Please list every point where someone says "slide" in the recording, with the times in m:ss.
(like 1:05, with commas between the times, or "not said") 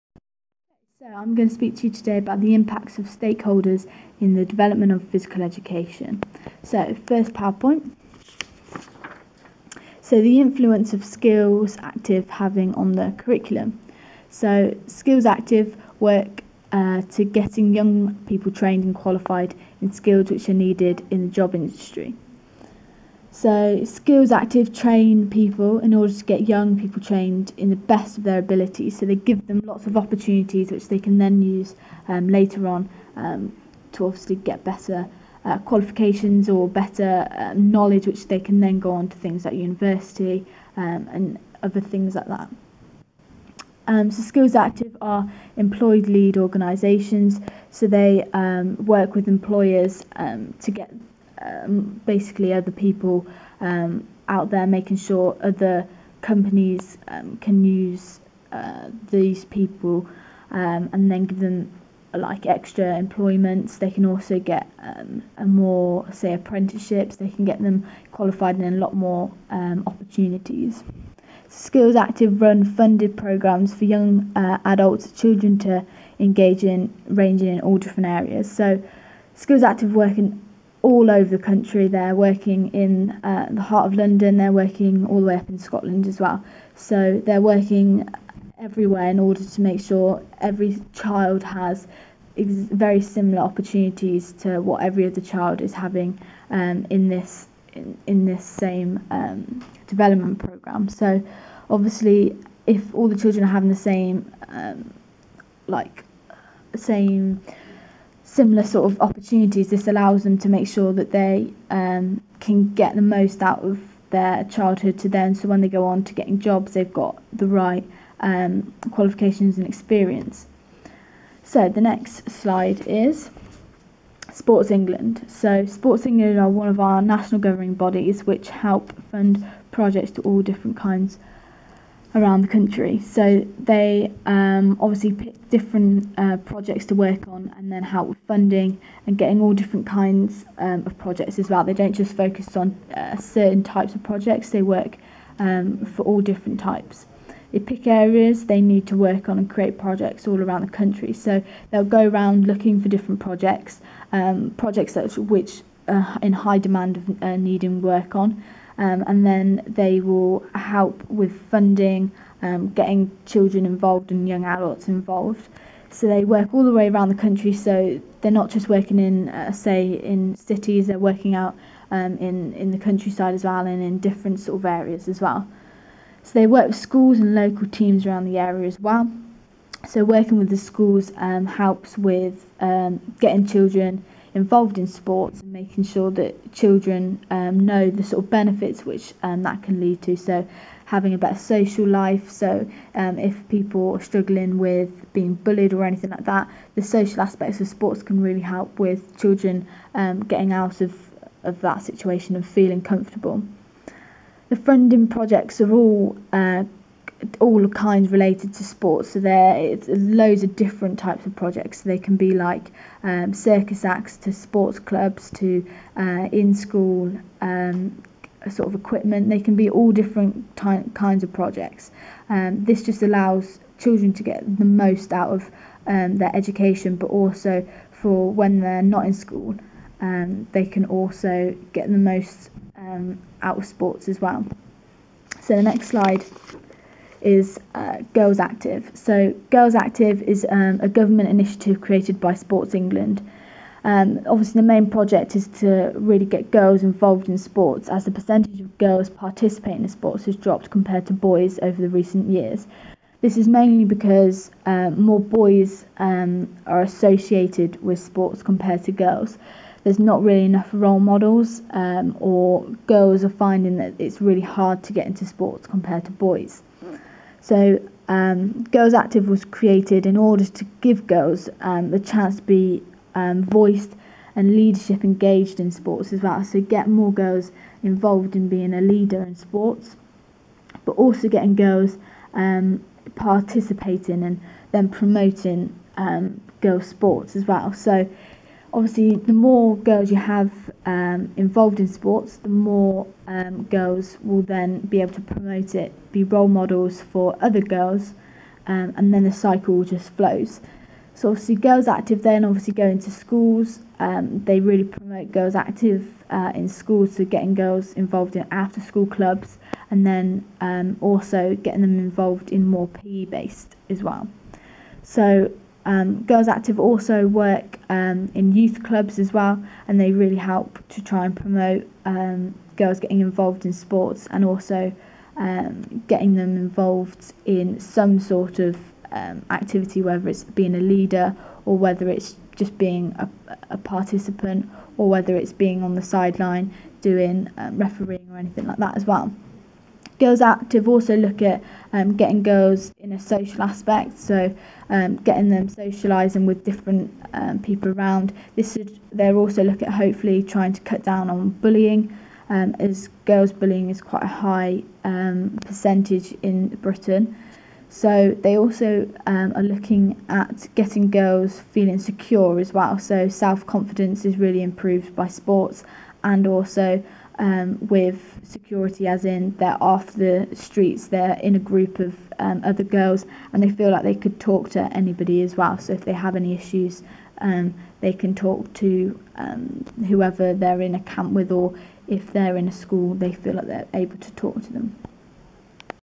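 2:02, 3:55.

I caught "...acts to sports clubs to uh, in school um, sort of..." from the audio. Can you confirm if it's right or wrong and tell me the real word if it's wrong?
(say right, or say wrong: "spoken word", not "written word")
right.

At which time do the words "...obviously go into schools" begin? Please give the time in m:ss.
5:02.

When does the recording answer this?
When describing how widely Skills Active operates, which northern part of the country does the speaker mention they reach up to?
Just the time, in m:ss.
1:25.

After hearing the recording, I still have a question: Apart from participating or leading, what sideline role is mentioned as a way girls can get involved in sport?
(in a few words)
Refereeing.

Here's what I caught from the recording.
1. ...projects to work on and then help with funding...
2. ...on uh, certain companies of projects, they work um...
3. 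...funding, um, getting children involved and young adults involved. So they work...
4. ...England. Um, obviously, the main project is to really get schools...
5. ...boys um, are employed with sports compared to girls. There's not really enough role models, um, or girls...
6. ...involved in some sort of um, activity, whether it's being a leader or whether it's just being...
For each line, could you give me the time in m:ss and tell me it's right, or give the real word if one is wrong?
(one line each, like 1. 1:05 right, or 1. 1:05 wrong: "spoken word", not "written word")
1. 2:16 right
2. 2:22 wrong: "types", not "companies"
3. 2:41 right
4. 4:02 wrong: "girls", not "schools"
5. 4:15 wrong: "associated", not "employed"
6. 5:26 right.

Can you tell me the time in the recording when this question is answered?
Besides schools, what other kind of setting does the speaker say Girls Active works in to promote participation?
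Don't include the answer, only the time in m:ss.
5:18.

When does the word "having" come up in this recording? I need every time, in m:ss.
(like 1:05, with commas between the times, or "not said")
0:12, 1:35, 1:43, 3:10.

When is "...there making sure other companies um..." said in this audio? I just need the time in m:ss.
0:54.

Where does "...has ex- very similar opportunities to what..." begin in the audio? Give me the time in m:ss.
1:31.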